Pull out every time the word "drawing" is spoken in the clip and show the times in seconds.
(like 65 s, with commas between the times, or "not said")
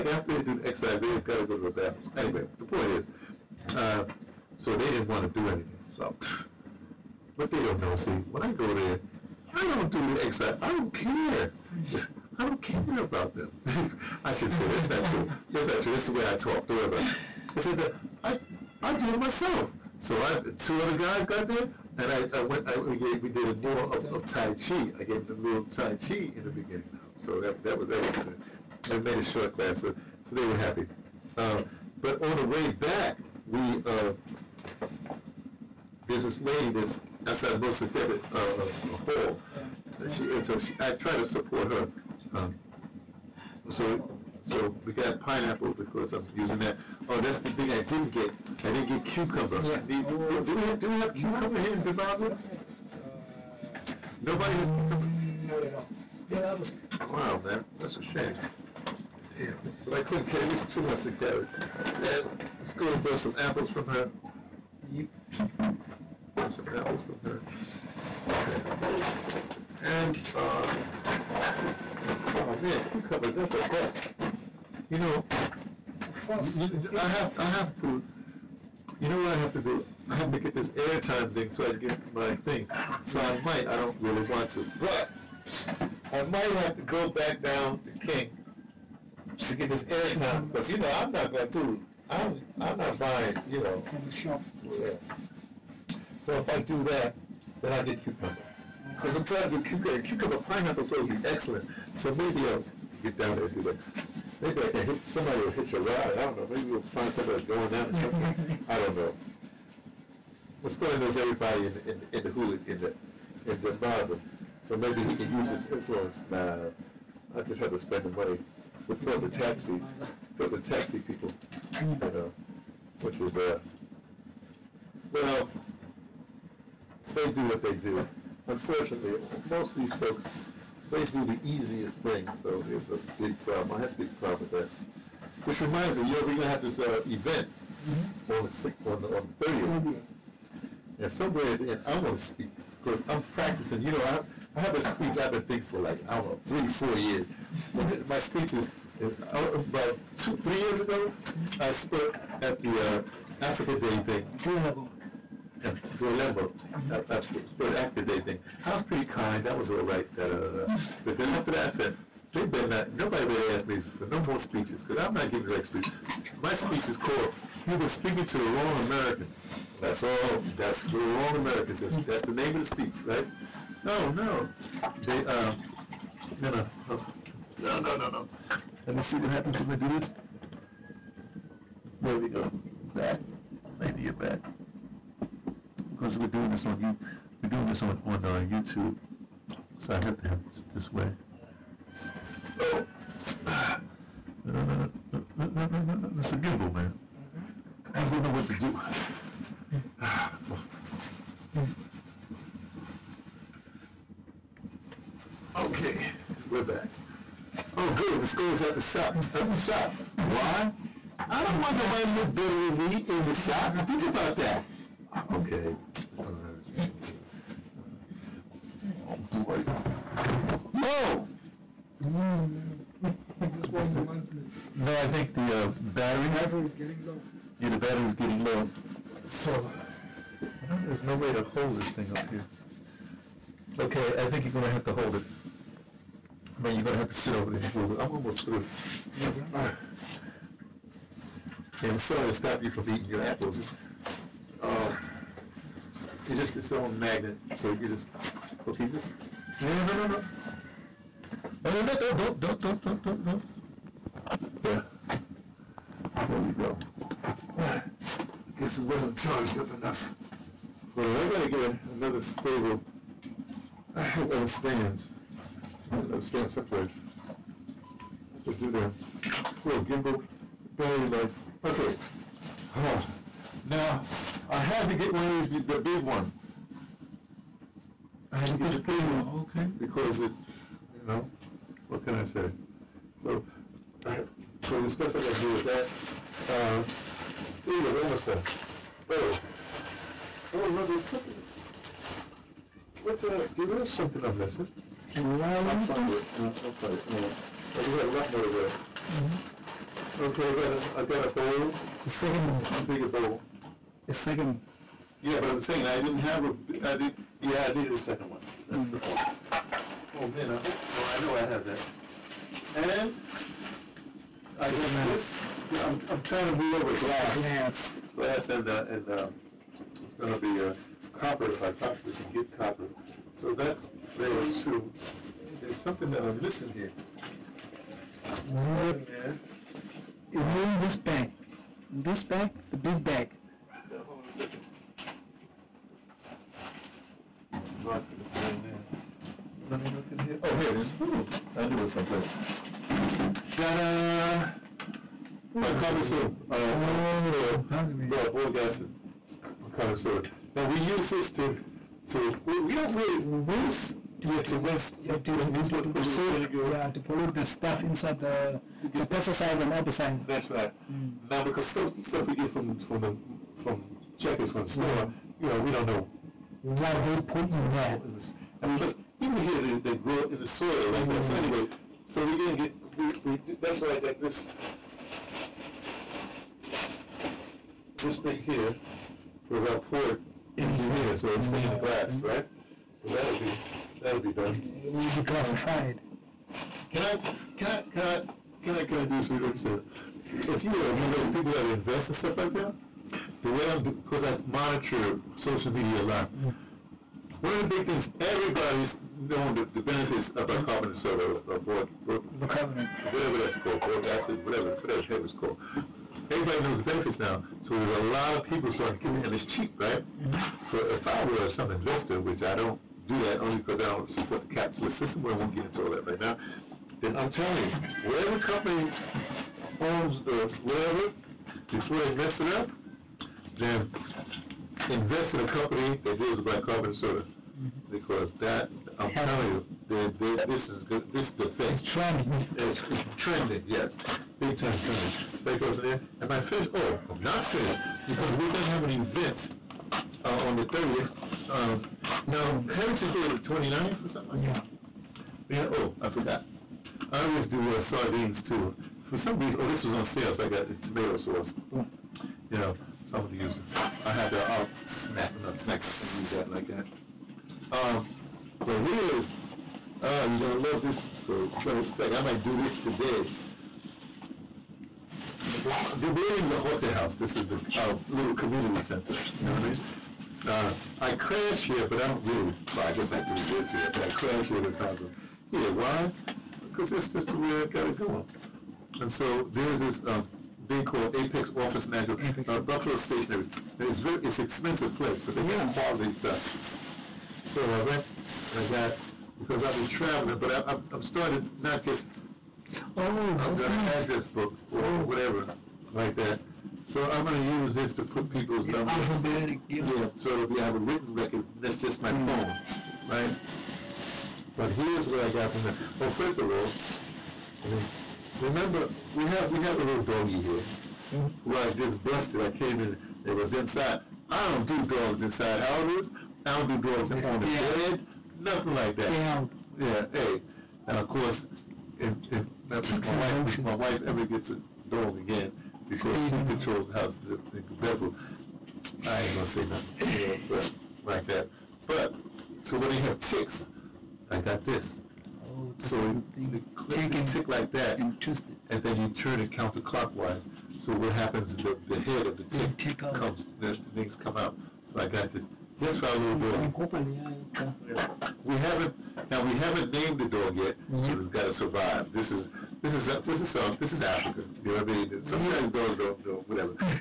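not said.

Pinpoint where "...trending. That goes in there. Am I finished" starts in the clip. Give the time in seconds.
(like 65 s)
434 s.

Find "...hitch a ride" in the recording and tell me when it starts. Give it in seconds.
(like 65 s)
105 s.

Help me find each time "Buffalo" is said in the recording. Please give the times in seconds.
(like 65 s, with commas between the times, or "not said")
482 s.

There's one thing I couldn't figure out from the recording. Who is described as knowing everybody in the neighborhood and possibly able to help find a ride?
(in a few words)
Masixole.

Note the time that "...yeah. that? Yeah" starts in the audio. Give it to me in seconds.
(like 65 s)
444 s.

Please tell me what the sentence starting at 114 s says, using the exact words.
So maybe he can use his influence.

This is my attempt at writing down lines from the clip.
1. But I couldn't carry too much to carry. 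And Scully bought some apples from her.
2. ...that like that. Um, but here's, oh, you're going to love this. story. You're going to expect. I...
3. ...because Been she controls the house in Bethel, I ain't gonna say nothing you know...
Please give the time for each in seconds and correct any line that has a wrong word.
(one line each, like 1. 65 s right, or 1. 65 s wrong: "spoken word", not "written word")
1. 59 s right
2. 456 s right
3. 525 s wrong: "Stay", not "Been".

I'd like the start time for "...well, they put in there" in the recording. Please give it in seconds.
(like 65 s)
366 s.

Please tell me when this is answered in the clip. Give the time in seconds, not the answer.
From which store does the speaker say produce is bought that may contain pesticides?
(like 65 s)
363 s.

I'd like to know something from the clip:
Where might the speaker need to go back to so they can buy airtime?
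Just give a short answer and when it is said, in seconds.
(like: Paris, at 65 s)
King, at 86 s.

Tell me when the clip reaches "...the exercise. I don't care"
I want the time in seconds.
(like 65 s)
10 s.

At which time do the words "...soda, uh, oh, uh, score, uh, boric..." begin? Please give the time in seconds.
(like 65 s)
346 s.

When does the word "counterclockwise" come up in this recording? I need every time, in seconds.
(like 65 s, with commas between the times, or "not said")
539 s.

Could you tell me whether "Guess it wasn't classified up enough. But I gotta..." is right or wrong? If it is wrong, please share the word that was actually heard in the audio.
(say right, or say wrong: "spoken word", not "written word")
wrong: "charged", not "classified".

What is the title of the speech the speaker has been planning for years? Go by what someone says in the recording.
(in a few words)
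You've Been Speaking to the Wrong American.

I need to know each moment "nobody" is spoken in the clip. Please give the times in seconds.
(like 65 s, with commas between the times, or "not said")
54 s, 162 s, 211 s.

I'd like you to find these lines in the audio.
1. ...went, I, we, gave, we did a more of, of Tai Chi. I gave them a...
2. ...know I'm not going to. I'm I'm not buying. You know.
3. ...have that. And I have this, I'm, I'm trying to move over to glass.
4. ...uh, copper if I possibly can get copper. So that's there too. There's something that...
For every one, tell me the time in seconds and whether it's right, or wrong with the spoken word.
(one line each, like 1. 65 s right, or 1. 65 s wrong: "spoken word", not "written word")
1. 22 s right
2. 90 s right
3. 311 s right
4. 320 s right.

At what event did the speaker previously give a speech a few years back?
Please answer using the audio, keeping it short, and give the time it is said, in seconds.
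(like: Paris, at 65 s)
Africa Day, at 153 s.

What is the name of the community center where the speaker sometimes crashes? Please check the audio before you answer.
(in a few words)
La Jota House.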